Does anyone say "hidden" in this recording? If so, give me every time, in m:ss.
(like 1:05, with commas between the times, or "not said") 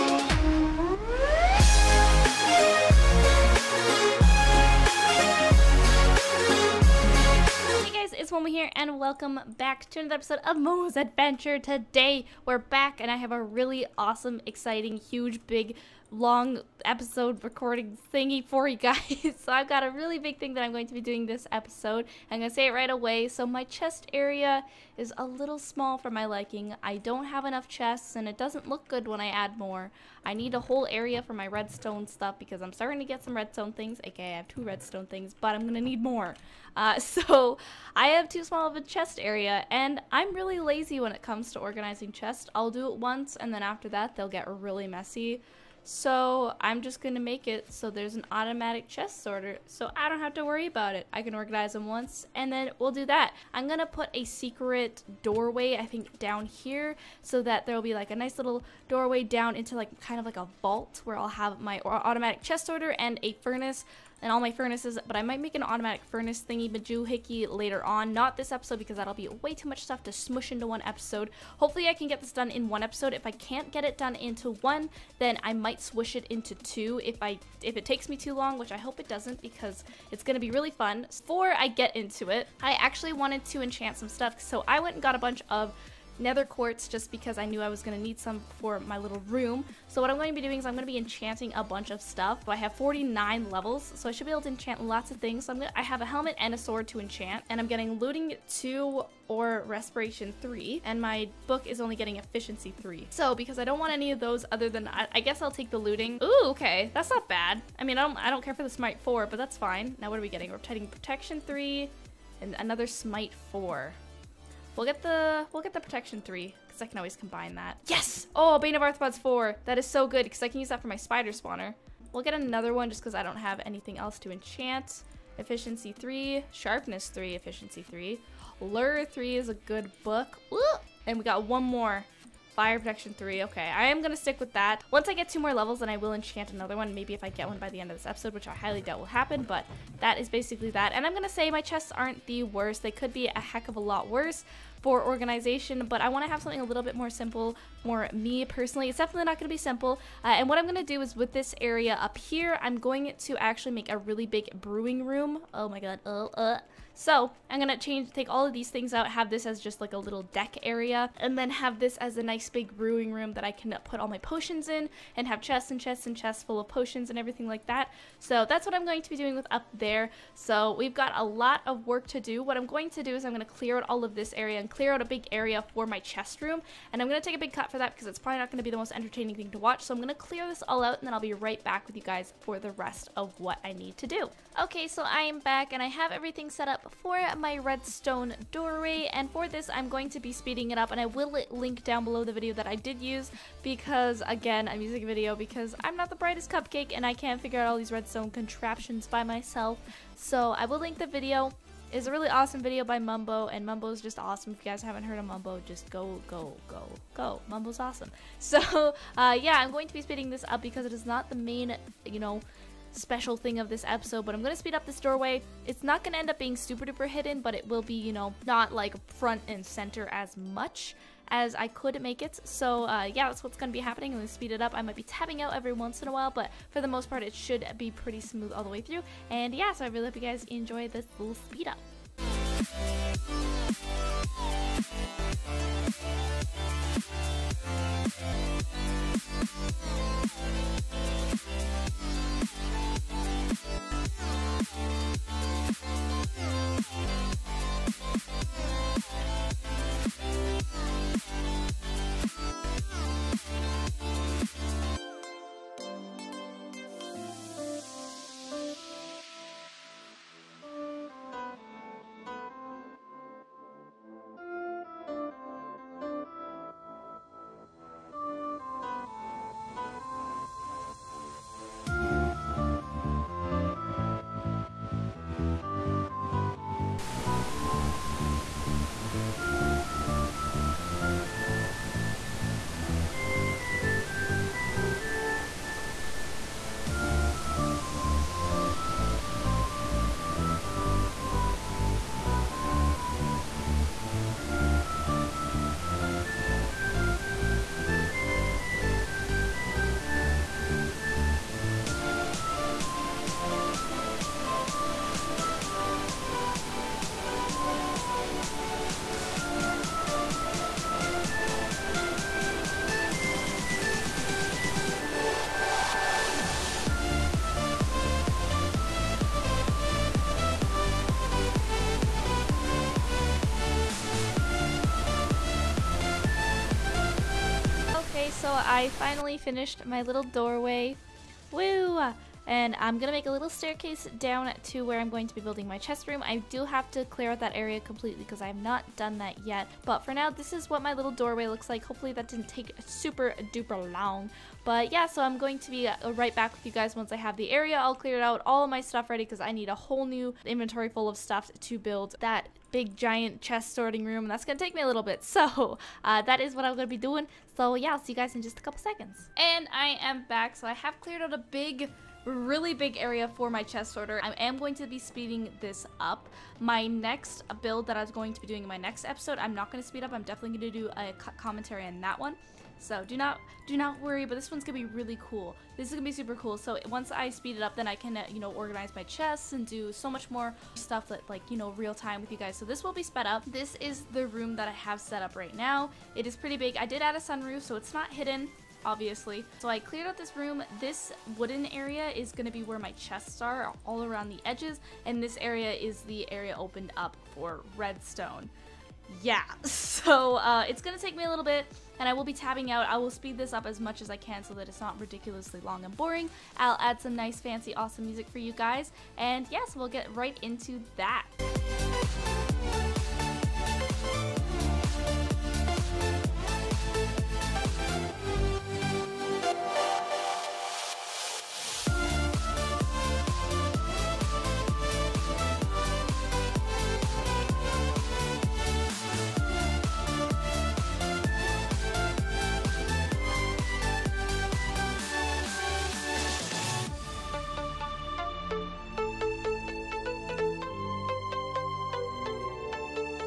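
3:37, 6:28.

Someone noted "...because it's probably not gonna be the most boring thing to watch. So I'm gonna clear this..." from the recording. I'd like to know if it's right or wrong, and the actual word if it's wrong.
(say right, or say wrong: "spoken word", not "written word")
wrong: "entertaining", not "boring".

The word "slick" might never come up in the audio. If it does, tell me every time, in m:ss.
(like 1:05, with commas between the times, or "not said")
not said.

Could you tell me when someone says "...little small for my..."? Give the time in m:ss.
0:25.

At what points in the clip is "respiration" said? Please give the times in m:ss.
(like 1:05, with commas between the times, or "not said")
1:39.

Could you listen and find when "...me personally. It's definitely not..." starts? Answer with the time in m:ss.
2:28.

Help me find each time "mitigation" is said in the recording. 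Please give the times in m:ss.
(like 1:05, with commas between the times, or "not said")
not said.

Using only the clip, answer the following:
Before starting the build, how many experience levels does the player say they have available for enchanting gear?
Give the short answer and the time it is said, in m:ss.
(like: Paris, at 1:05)
49, at 1:32.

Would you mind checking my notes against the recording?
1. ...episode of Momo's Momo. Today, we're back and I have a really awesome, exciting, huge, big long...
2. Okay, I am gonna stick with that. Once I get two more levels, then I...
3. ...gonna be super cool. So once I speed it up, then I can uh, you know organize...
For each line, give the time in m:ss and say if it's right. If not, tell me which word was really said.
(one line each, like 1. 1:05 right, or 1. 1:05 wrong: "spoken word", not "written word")
1. 0:10 wrong: "Adventure", not "Momo"
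2. 2:13 right
3. 6:15 right.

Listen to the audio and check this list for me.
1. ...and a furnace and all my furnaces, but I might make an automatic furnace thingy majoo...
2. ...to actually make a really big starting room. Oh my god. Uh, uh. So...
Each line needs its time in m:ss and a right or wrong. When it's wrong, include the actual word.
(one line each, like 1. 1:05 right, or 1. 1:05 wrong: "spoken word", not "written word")
1. 1:02 right
2. 2:33 wrong: "brewing", not "starting".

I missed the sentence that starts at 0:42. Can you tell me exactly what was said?
I'll do it once and then after that they'll get really messy.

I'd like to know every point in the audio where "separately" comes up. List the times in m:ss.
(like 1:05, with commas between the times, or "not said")
not said.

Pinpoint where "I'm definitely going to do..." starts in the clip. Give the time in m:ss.
6:10.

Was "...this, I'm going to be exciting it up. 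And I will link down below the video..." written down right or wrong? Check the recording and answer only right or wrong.
wrong.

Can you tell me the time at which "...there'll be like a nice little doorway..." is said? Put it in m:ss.
0:57.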